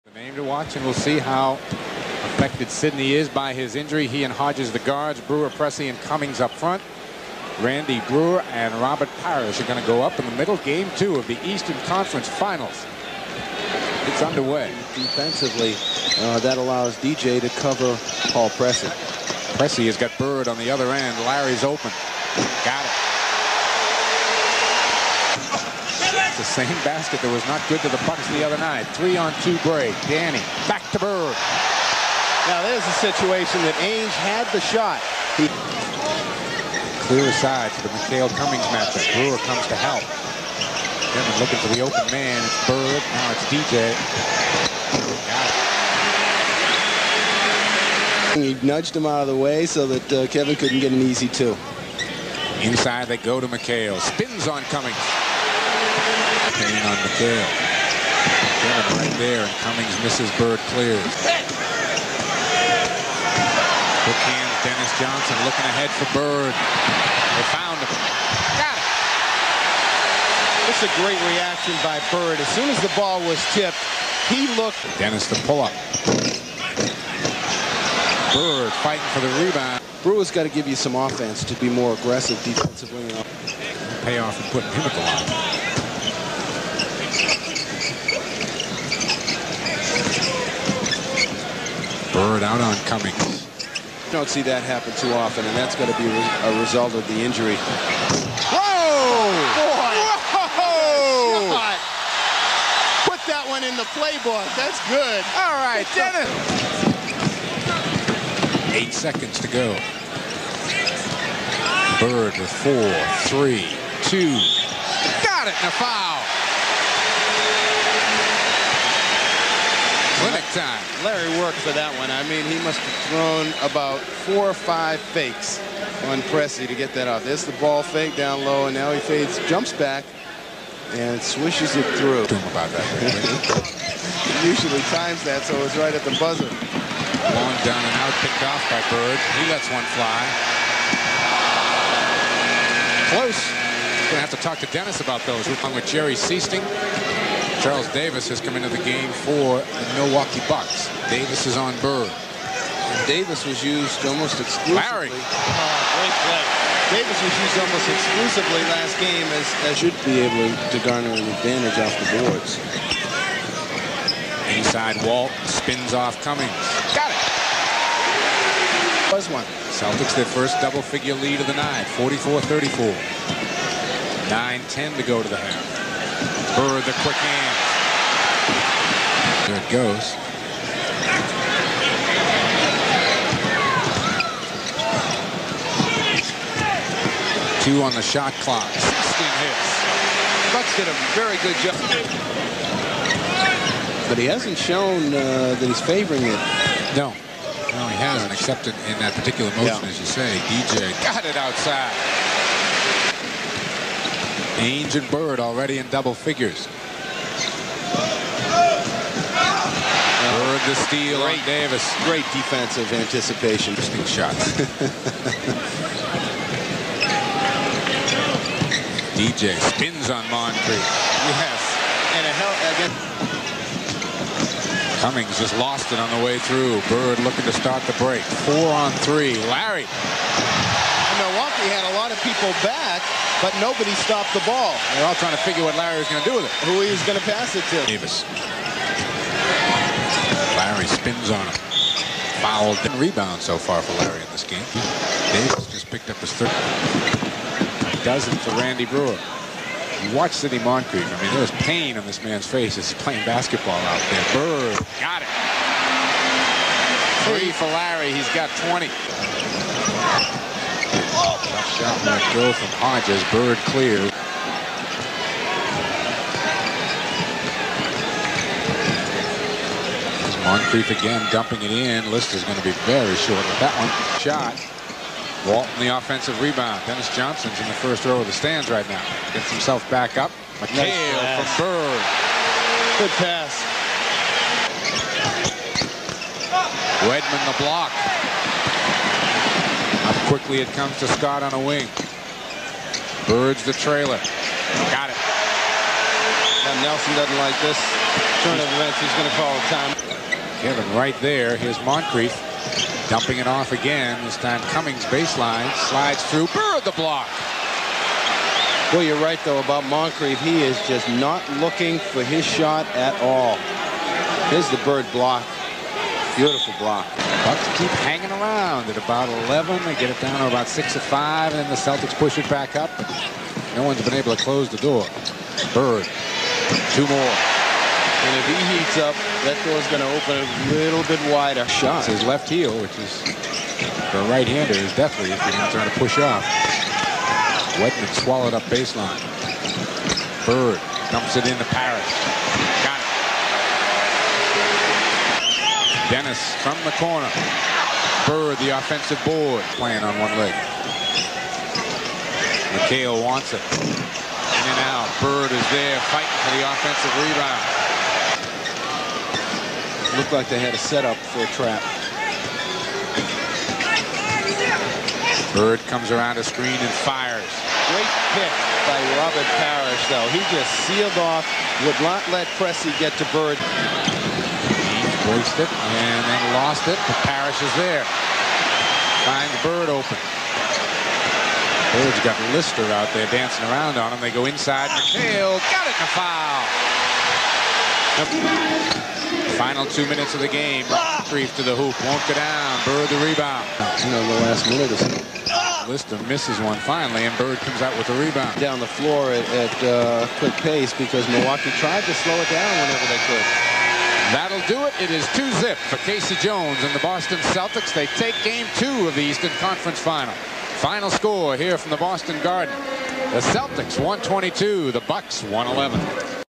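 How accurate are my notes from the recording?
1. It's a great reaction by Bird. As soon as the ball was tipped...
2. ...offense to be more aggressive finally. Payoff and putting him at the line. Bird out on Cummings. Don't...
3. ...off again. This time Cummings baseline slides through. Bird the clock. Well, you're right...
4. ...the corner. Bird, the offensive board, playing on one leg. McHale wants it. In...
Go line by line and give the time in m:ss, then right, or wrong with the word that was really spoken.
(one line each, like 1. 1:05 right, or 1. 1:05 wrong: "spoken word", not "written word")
1. 1:10 right
2. 1:20 wrong: "defensively", not "finally"
3. 5:03 wrong: "block", not "clock"
4. 5:46 right.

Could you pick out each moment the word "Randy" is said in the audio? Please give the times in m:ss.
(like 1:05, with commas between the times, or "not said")
0:07, 4:08.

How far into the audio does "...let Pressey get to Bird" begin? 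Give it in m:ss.
6:12.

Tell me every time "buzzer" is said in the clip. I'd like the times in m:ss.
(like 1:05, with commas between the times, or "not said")
2:16.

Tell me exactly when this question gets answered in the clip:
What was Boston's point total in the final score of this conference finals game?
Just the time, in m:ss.
6:53.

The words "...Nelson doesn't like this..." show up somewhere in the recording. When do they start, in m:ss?
4:56.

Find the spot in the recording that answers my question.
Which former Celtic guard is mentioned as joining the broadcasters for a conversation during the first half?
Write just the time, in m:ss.
2:25.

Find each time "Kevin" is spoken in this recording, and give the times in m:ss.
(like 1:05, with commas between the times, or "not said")
0:50, 0:58, 5:00.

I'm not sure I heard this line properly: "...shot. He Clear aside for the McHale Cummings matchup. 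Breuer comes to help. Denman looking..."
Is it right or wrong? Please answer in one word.
right.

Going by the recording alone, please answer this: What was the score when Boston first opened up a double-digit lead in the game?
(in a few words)
44-34.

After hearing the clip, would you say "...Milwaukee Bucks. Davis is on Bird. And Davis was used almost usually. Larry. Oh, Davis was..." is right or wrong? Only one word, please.
wrong.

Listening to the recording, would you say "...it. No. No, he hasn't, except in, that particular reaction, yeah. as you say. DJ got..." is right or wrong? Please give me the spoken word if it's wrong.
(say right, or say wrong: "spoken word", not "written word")
wrong: "motion", not "reaction".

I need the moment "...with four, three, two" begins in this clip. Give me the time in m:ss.
1:52.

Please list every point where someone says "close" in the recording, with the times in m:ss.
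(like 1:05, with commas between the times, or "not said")
2:23, 5:24.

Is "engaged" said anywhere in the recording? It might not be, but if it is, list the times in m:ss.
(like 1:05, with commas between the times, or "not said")
not said.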